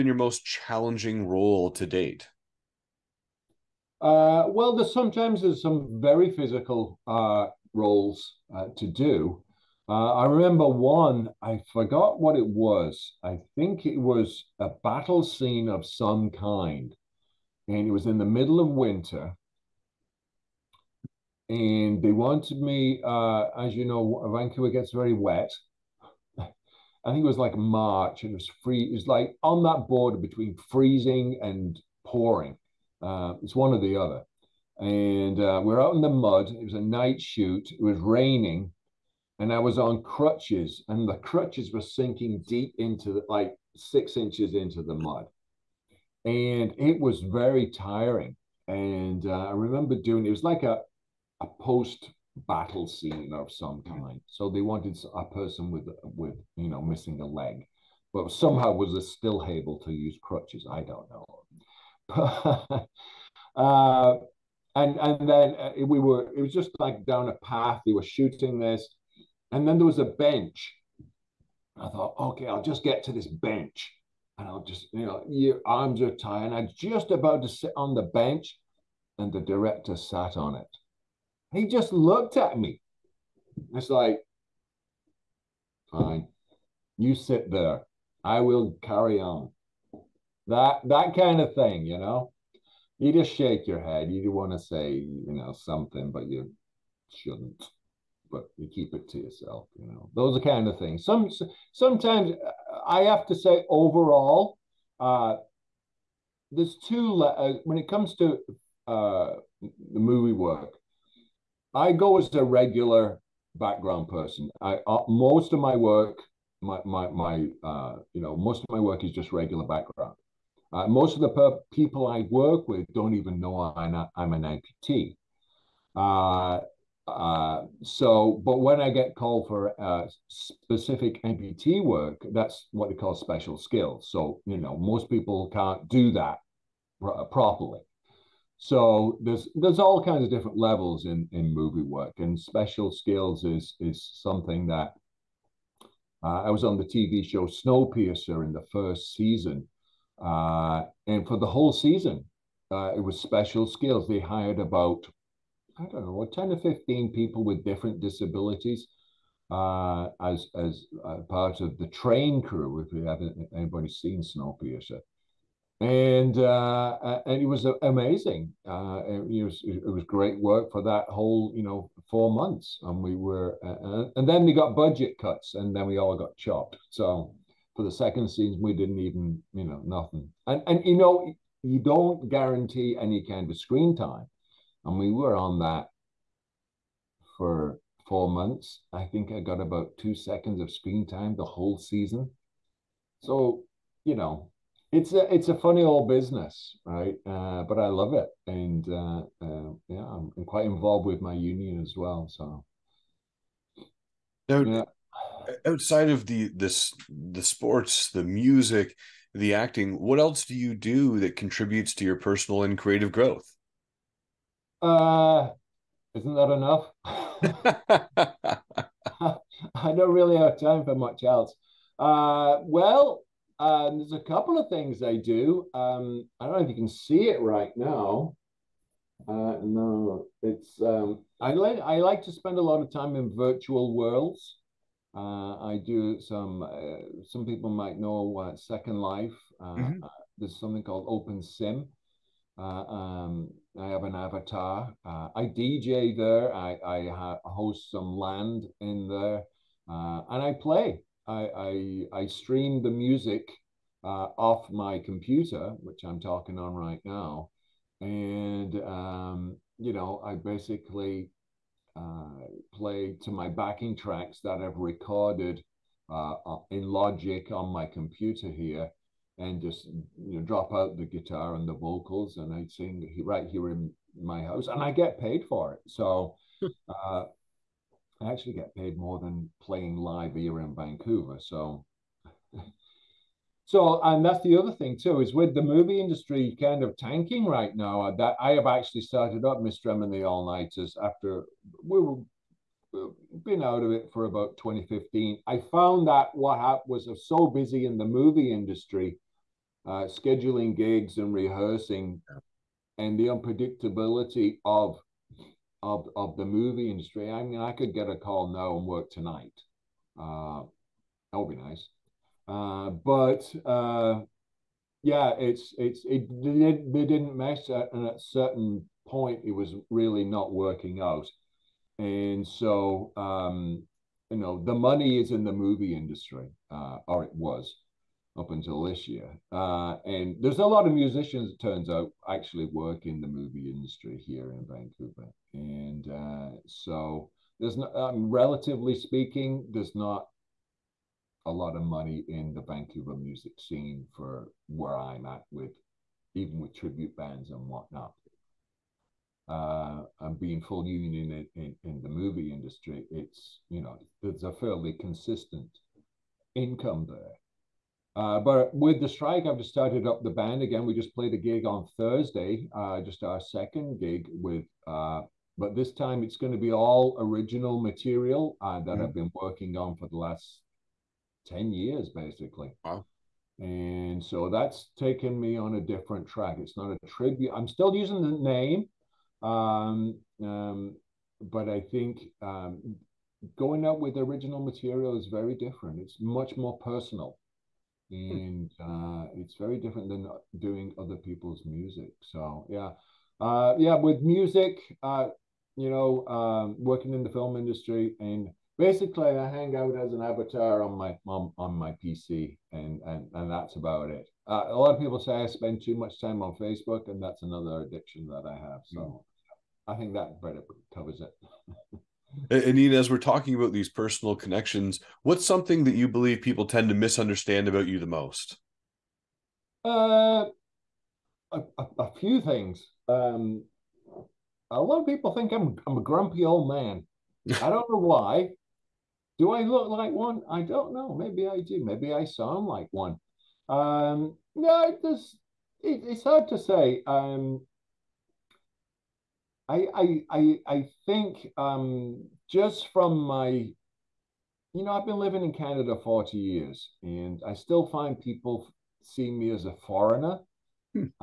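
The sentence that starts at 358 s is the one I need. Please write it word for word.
Uh, but with the strike, I've just started up the band again.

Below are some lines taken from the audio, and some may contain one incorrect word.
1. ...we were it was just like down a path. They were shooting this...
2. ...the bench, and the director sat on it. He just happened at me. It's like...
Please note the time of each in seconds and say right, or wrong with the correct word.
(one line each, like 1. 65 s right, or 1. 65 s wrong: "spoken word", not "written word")
1. 65 s right
2. 77 s wrong: "looked", not "happened".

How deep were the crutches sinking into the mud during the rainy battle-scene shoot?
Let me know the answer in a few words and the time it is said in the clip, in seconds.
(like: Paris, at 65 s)
6 inches, at 43 s.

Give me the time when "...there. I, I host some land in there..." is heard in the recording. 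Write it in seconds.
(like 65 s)
246 s.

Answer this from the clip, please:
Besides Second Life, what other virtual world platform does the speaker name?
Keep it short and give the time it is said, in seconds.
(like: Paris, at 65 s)
Open Sim, at 241 s.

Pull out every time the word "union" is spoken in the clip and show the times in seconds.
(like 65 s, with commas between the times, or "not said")
201 s, 350 s.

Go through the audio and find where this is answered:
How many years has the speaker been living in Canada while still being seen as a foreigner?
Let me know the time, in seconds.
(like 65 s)
446 s.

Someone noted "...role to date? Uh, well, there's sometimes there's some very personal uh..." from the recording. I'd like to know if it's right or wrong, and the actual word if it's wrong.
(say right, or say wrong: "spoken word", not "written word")
wrong: "physical", not "personal".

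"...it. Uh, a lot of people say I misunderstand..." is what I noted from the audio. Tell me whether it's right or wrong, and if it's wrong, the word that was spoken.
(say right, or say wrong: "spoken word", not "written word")
wrong: "spend", not "misunderstand".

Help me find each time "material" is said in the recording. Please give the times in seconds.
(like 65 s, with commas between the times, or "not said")
367 s, 384 s.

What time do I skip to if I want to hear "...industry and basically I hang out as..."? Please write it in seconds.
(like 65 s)
397 s.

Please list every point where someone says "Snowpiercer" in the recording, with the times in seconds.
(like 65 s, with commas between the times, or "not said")
147 s, 164 s.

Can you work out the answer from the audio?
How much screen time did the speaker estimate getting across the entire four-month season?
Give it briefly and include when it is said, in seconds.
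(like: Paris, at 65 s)
2 seconds, at 189 s.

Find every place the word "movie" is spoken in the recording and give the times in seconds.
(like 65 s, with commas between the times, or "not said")
109 s, 141 s, 285 s, 298 s, 306 s, 325 s, 333 s, 352 s.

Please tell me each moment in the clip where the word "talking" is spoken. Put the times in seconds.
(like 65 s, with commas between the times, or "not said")
256 s, 413 s.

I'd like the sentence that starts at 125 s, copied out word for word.
Uh, uh, so, but when I get called for uh, specific amputee work, that's what they call special skills.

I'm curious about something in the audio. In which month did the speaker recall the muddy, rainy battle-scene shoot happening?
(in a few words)
March.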